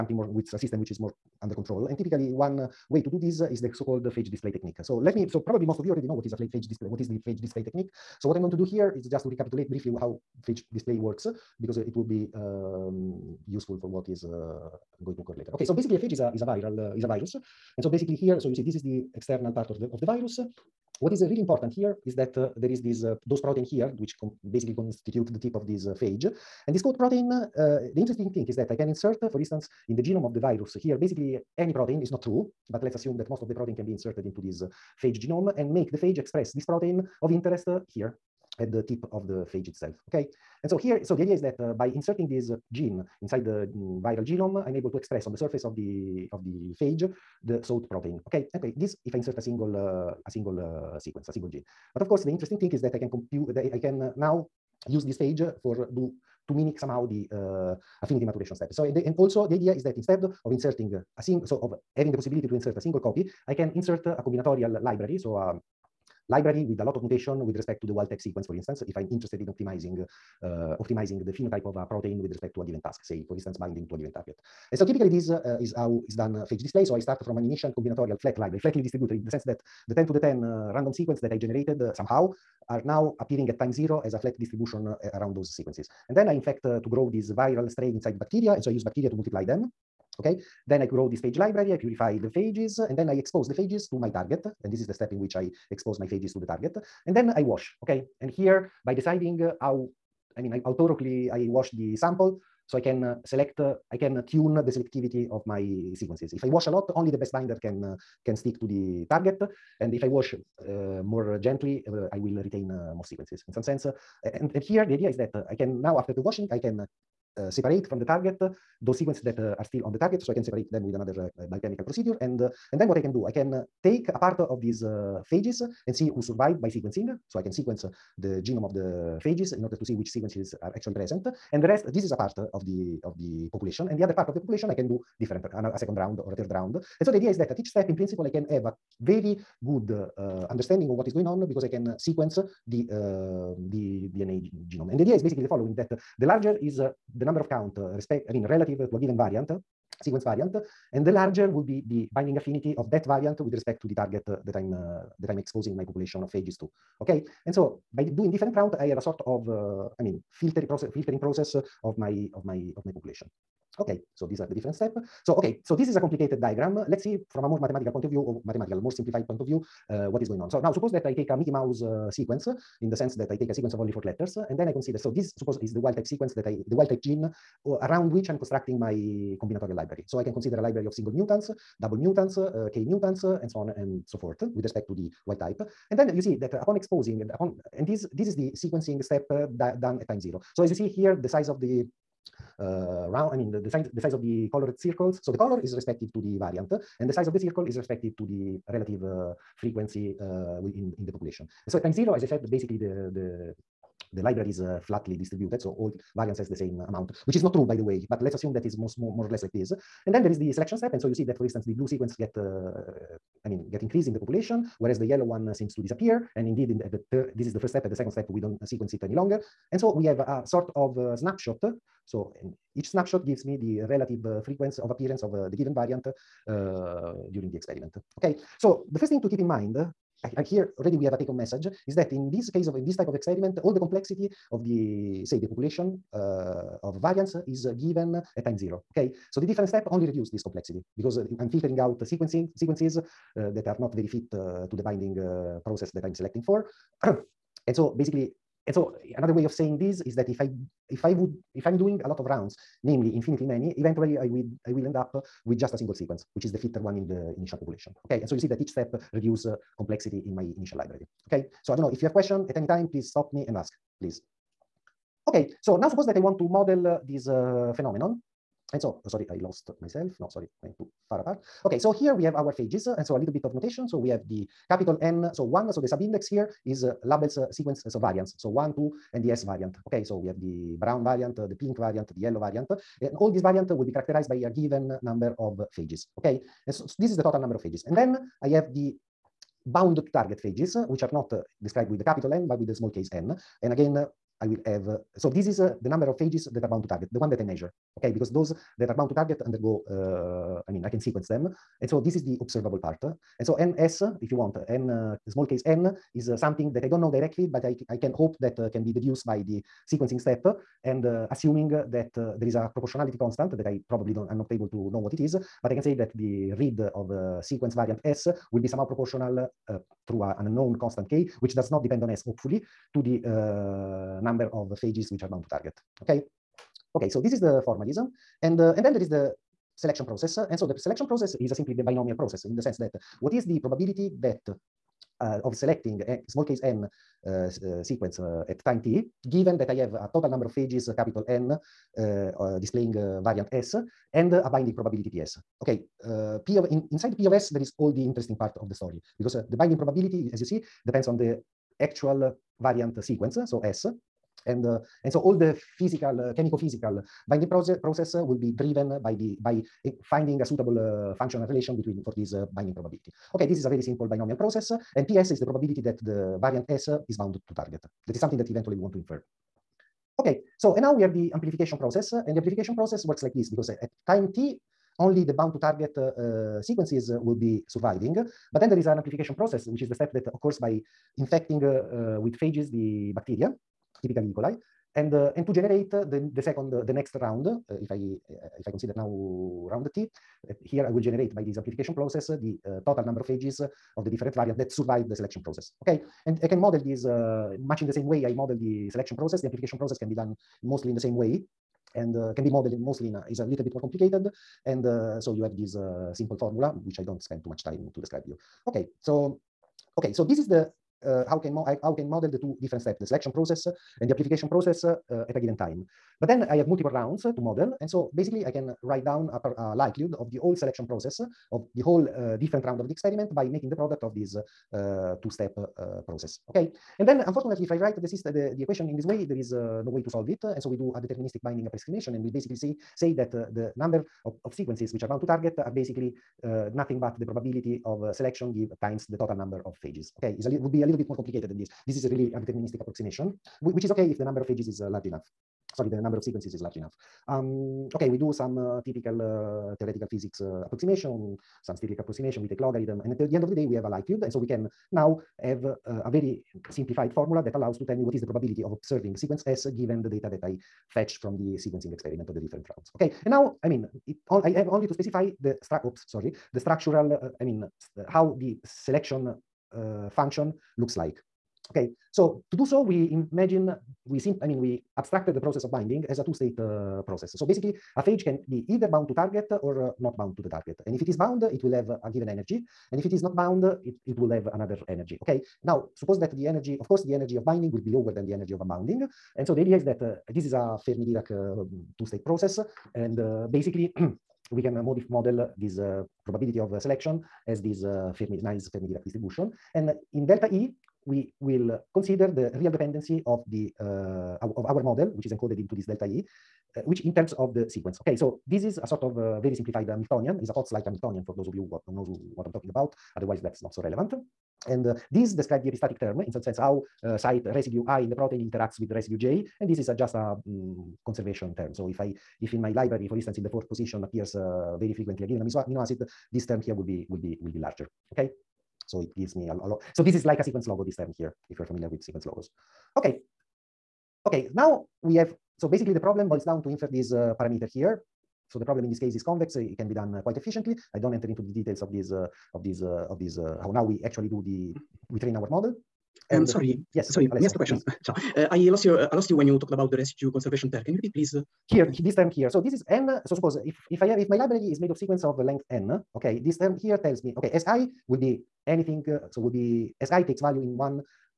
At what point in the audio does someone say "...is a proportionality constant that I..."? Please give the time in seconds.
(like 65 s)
312 s.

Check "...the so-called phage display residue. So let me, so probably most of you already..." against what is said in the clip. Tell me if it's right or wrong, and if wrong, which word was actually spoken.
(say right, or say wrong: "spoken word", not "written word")
wrong: "technique", not "residue".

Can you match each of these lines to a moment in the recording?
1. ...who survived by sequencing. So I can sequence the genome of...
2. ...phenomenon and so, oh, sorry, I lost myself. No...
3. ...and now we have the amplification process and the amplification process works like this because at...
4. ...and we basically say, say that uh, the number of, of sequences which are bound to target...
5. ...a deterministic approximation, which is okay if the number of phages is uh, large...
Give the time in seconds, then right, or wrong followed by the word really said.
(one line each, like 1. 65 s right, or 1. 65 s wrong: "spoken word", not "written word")
1. 126 s right
2. 267 s right
3. 370 s right
4. 432 s right
5. 442 s right.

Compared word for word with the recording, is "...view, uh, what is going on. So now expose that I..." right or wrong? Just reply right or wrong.
wrong.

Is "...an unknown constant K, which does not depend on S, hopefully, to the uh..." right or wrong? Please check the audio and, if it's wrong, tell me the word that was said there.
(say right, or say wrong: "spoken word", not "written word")
right.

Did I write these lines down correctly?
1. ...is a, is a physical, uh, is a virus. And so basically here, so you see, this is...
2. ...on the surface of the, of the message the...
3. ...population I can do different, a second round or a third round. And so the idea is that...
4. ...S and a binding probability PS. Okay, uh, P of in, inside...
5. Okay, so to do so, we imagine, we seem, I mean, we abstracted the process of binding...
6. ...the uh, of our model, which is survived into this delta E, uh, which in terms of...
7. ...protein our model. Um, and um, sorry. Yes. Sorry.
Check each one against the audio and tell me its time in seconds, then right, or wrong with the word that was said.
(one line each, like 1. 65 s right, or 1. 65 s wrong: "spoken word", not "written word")
1. 16 s wrong: "viral", not "physical"
2. 45 s wrong: "phage", not "message"
3. 134 s right
4. 343 s right
5. 471 s right
6. 503 s wrong: "encoded", not "survived"
7. 545 s wrong: "train", not "protein".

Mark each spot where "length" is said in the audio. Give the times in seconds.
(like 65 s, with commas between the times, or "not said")
555 s.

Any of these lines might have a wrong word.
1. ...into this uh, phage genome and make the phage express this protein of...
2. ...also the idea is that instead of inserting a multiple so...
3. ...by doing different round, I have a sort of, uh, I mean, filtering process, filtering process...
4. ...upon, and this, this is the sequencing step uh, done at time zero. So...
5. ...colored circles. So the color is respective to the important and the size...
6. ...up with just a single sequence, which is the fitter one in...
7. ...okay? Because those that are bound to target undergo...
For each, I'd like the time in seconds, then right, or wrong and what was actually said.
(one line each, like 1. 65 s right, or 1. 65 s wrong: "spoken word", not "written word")
1. 34 s right
2. 59 s wrong: "single", not "multiple"
3. 157 s right
4. 187 s right
5. 194 s wrong: "variant", not "important"
6. 254 s right
7. 297 s right.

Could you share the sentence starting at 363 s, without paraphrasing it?
Okay, this is a very simple binomial process, uh, and PS is the probability that the variant S is bound to target.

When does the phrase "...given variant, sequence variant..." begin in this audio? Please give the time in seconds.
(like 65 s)
148 s.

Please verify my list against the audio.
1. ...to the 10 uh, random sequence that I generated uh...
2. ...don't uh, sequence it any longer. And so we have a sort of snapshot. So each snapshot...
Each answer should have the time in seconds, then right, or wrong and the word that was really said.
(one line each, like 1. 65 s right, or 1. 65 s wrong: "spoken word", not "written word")
1. 80 s right
2. 218 s right.